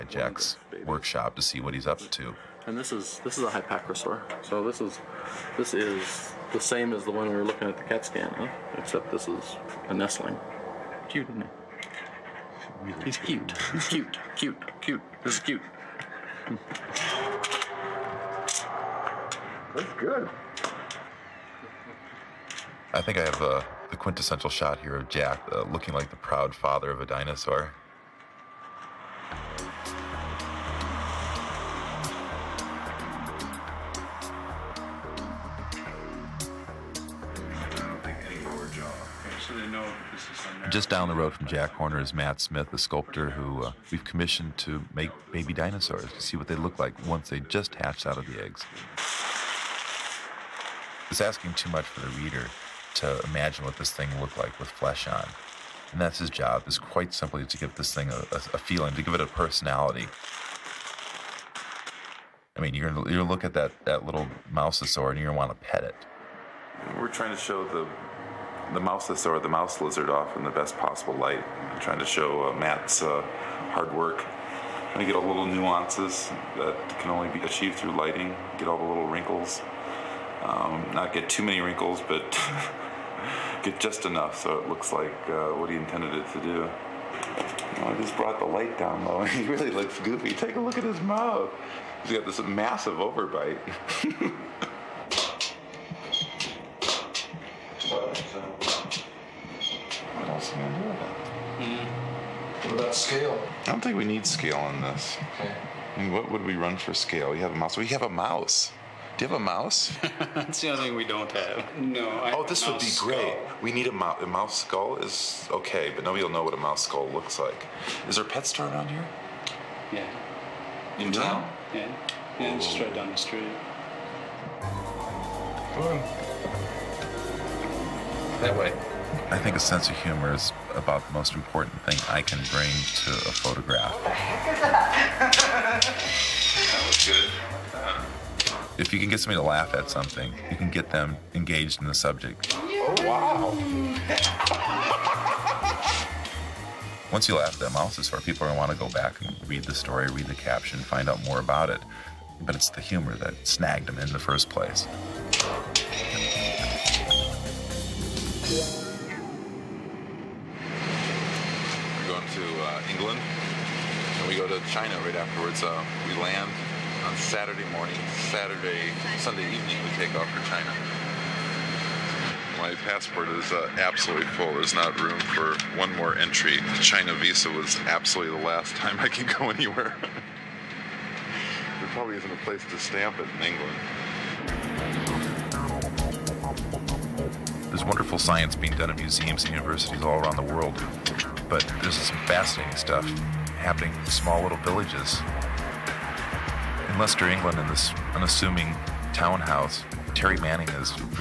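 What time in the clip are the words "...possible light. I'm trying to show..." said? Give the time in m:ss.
1:10.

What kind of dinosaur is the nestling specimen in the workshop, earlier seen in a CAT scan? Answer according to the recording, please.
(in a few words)
hypacrosaur.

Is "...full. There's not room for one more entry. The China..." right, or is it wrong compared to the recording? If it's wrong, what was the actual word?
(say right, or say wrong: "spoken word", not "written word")
right.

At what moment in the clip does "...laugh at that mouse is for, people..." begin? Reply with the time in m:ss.
2:27.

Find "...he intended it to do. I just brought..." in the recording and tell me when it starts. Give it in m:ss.
1:25.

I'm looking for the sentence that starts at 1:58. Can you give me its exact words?
Is there a pet store around here?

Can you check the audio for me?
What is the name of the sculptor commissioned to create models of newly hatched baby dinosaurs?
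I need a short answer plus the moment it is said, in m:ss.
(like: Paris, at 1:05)
Matt Smith, at 0:42.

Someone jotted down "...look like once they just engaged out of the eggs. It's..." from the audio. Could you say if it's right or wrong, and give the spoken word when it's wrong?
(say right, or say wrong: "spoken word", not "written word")
wrong: "hatched", not "engaged".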